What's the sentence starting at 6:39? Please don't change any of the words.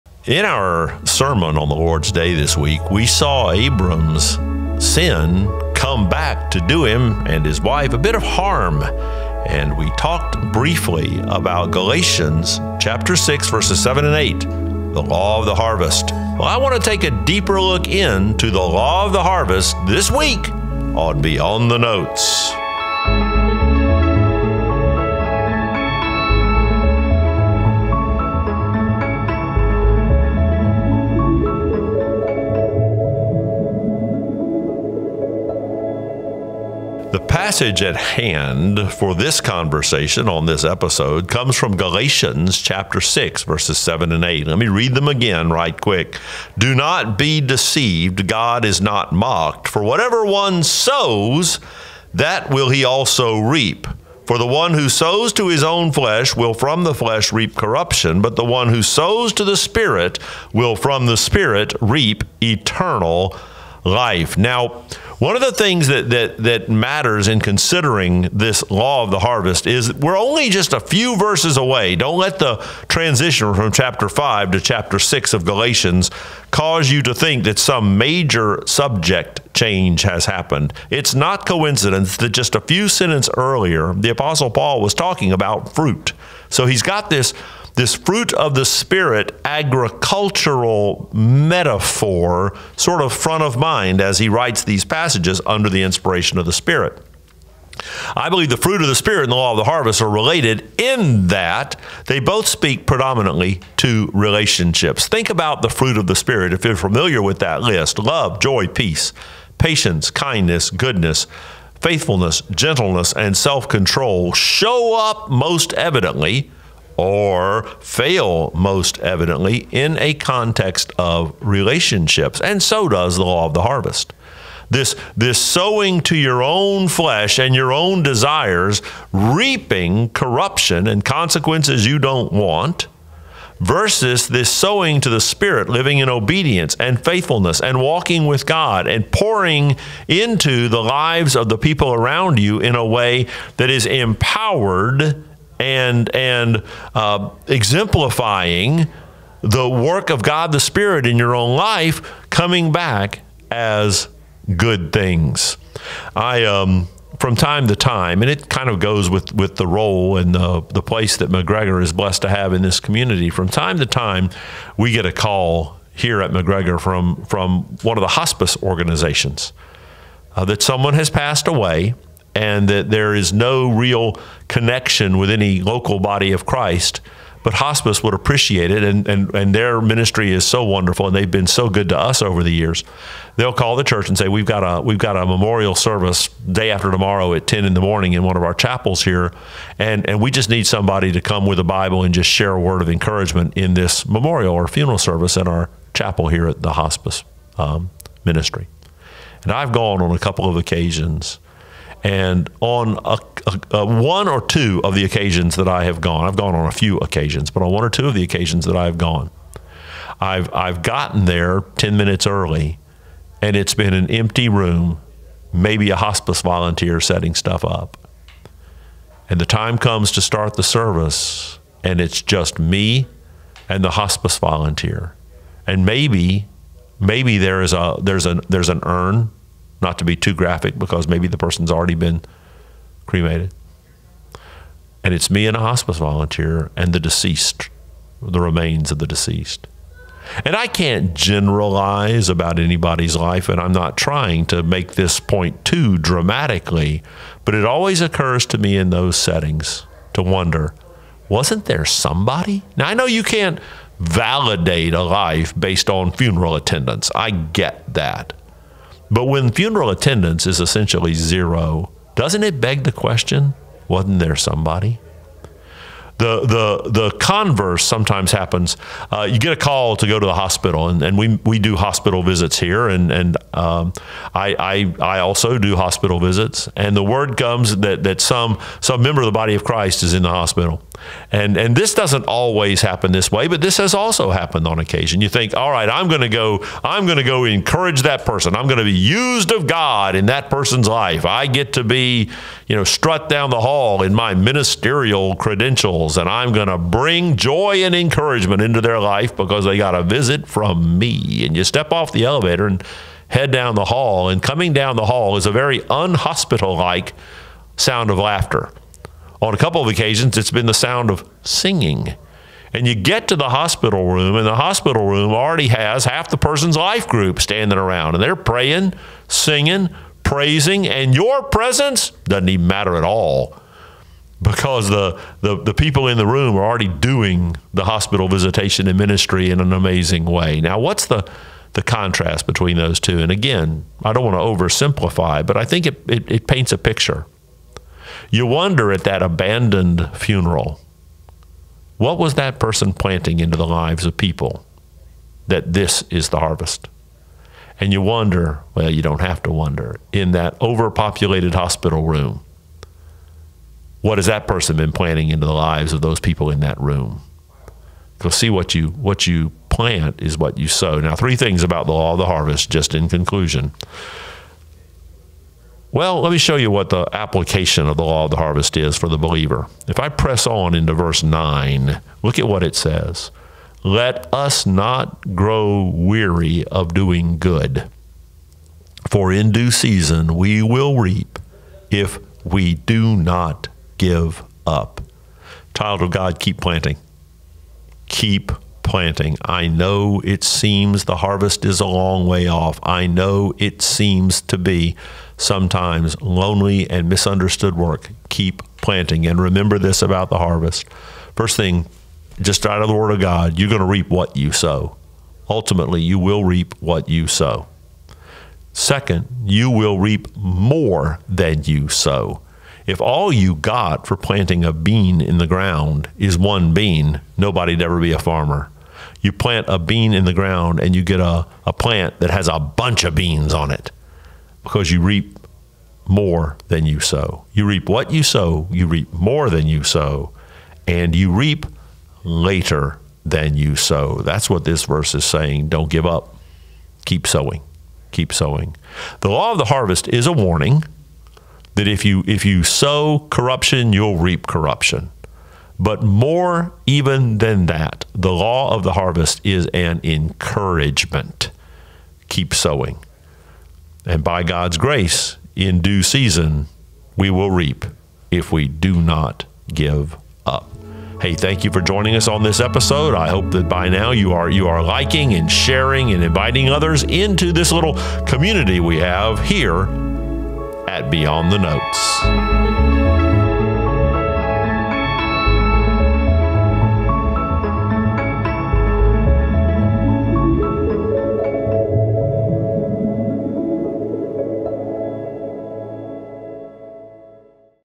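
And remember this about the harvest.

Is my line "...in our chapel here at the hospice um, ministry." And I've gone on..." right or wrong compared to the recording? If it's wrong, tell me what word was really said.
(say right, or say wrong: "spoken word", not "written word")
right.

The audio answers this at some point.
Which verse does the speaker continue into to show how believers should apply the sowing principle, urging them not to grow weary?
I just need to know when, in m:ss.
6:10.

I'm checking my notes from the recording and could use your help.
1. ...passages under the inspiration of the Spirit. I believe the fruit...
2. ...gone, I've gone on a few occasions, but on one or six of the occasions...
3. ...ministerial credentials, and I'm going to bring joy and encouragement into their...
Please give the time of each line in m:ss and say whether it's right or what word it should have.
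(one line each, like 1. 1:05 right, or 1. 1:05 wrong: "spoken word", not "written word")
1. 1:34 right
2. 3:26 wrong: "two", not "six"
3. 4:54 right.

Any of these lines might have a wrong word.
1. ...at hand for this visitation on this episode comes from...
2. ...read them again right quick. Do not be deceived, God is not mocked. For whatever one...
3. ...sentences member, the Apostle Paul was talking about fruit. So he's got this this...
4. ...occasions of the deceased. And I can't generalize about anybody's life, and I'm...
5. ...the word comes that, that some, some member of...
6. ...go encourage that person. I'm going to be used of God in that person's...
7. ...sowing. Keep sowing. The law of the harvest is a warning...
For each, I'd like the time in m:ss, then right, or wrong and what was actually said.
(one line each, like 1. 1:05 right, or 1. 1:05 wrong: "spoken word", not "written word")
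1. 0:37 wrong: "conversation", not "visitation"
2. 0:44 right
3. 1:22 wrong: "earlier", not "member"
4. 3:58 wrong: "remains", not "occasions"
5. 4:36 right
6. 4:47 right
7. 7:17 right.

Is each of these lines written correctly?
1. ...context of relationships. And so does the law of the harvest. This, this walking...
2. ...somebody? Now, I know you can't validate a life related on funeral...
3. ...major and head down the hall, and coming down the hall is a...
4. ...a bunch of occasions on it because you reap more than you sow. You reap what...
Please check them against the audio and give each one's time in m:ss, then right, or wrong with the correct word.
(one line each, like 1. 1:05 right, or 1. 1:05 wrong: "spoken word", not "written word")
1. 2:00 wrong: "sowing", not "walking"
2. 4:11 wrong: "based", not "related"
3. 5:02 wrong: "elevator", not "major"
4. 7:02 wrong: "beans", not "occasions".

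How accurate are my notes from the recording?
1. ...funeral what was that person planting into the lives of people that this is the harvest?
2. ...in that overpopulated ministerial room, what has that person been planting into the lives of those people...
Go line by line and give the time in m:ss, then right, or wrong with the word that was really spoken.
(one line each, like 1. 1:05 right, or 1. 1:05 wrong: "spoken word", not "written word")
1. 5:40 right
2. 5:50 wrong: "hospital", not "ministerial".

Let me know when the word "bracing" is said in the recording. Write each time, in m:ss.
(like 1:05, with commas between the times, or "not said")
not said.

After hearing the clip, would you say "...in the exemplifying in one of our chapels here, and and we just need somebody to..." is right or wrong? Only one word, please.
wrong.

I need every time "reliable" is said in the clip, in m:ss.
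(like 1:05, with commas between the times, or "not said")
not said.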